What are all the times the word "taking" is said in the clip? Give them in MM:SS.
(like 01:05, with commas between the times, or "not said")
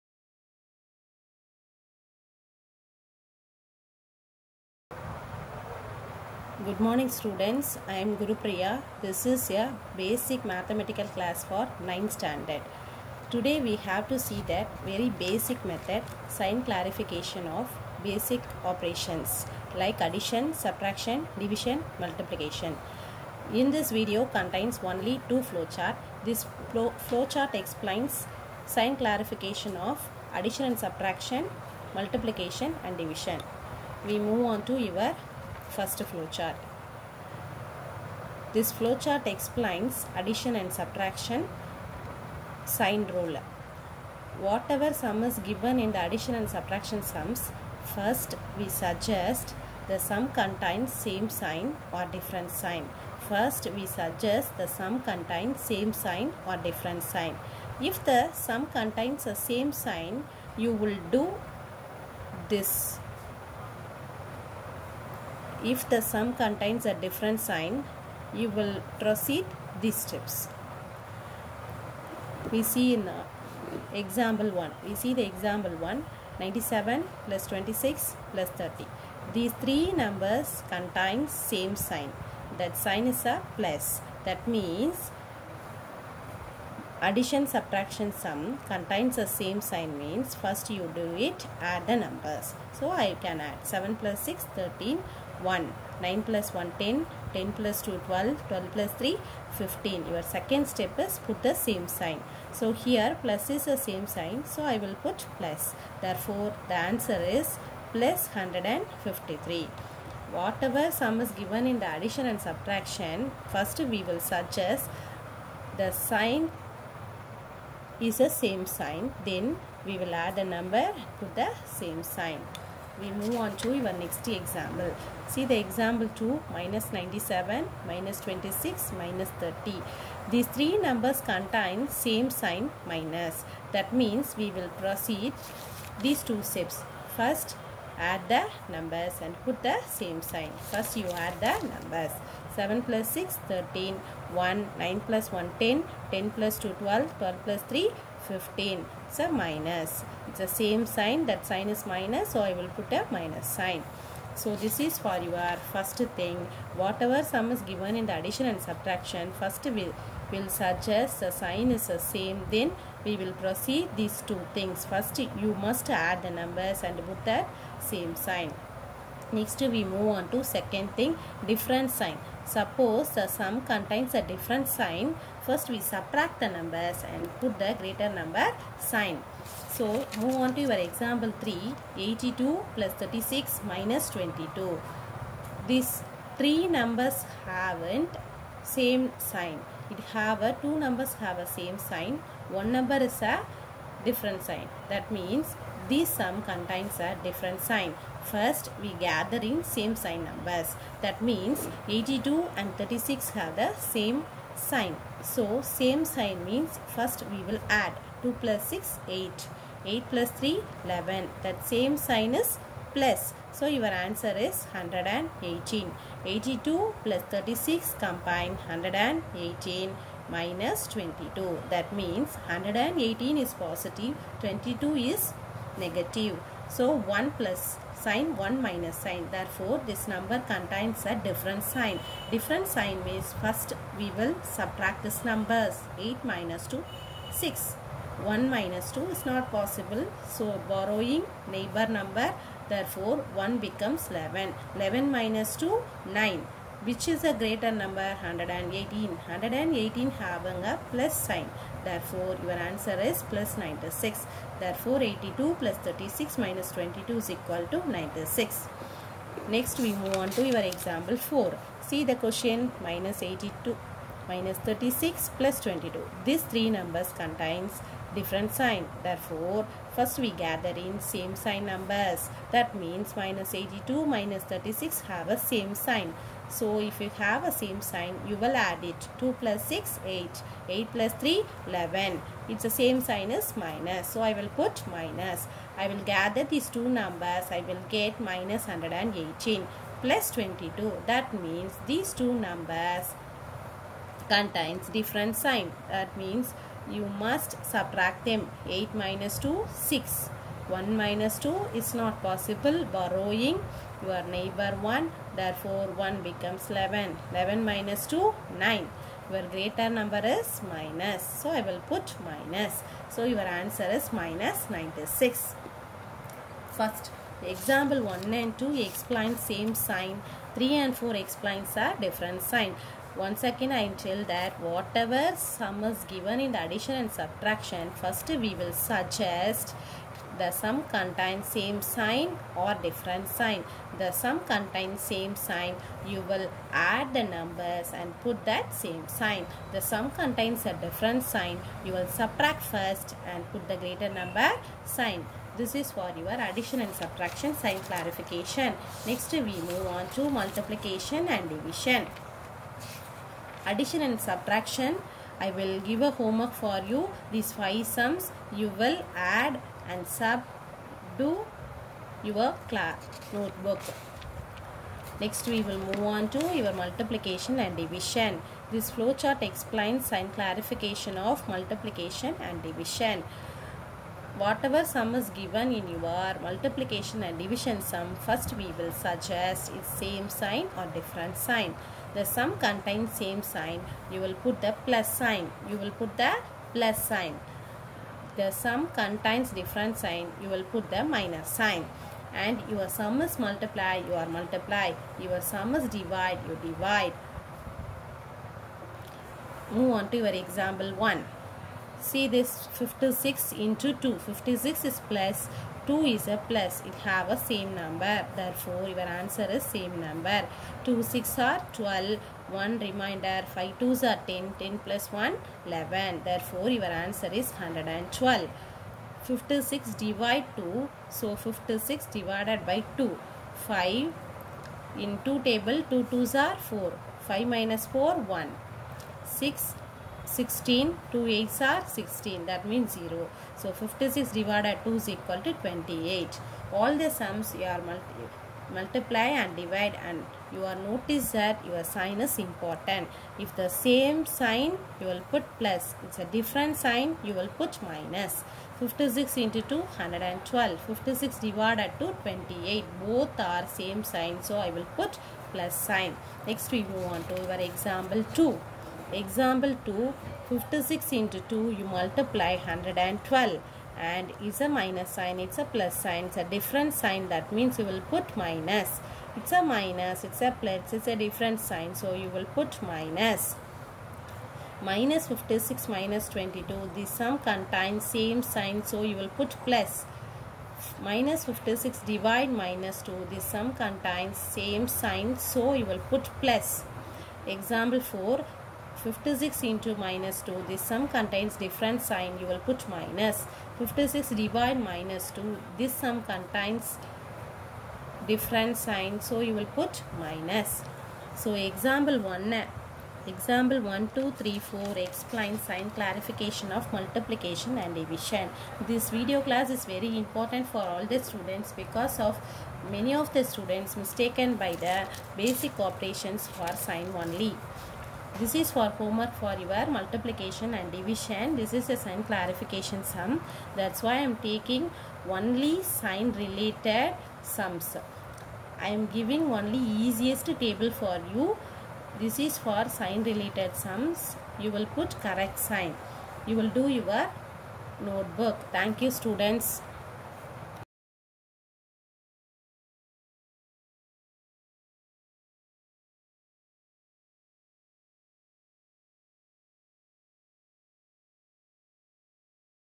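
08:44.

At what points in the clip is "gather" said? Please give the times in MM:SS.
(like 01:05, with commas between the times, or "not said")
03:18, 04:30, 04:46.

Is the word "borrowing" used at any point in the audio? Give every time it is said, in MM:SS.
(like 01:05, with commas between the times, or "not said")
04:00, 05:02.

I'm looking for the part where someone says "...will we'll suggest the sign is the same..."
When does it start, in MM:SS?
02:39.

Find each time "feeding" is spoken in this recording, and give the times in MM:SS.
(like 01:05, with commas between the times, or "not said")
not said.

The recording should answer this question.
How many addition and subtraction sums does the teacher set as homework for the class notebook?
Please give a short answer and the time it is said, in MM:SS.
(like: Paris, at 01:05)
5, at 05:57.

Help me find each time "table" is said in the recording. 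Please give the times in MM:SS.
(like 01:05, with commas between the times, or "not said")
07:05, 08:50.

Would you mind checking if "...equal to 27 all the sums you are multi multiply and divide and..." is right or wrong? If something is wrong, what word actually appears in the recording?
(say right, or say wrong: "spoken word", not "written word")
wrong: "28", not "27".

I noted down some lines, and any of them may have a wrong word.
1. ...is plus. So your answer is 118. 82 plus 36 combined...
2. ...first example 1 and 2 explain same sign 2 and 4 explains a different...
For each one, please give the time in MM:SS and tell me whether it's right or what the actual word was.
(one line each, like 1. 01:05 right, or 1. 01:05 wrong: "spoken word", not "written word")
1. 03:32 right
2. 05:16 wrong: "3", not "2".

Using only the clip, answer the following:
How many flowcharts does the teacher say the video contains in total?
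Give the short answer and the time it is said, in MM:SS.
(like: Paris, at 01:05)
2, at 00:25.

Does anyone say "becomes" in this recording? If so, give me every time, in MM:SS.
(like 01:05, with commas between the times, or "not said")
04:03, 05:06.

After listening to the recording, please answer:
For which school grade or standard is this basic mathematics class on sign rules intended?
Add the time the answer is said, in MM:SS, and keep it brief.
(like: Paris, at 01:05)
9th, at 00:11.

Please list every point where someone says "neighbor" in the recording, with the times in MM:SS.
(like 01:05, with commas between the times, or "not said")
04:01, 05:04.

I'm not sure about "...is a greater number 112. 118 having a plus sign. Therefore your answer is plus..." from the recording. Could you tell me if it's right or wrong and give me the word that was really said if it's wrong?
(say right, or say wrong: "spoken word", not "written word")
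wrong: "118", not "112".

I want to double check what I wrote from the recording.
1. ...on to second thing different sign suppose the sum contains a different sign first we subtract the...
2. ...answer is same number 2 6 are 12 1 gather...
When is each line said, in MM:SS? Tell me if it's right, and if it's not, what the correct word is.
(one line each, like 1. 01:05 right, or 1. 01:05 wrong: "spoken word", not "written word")
1. 02:50 right
2. 06:49 wrong: "reminder", not "gather".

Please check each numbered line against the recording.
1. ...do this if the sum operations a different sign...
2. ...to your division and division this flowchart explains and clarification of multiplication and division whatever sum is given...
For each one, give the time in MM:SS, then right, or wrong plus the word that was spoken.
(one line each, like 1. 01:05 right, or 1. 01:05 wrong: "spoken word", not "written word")
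1. 01:01 wrong: "contains", not "operations"
2. 06:06 wrong: "multiplication", not "division".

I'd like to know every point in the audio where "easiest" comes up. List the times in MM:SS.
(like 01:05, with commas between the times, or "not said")
08:49.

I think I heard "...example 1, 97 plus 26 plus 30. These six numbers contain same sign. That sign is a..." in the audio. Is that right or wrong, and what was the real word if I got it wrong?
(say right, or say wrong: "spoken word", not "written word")
wrong: "three", not "six".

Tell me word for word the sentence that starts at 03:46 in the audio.
So 1 plus sign, 1 minus sign.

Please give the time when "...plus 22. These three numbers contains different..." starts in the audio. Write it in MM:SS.
04:25.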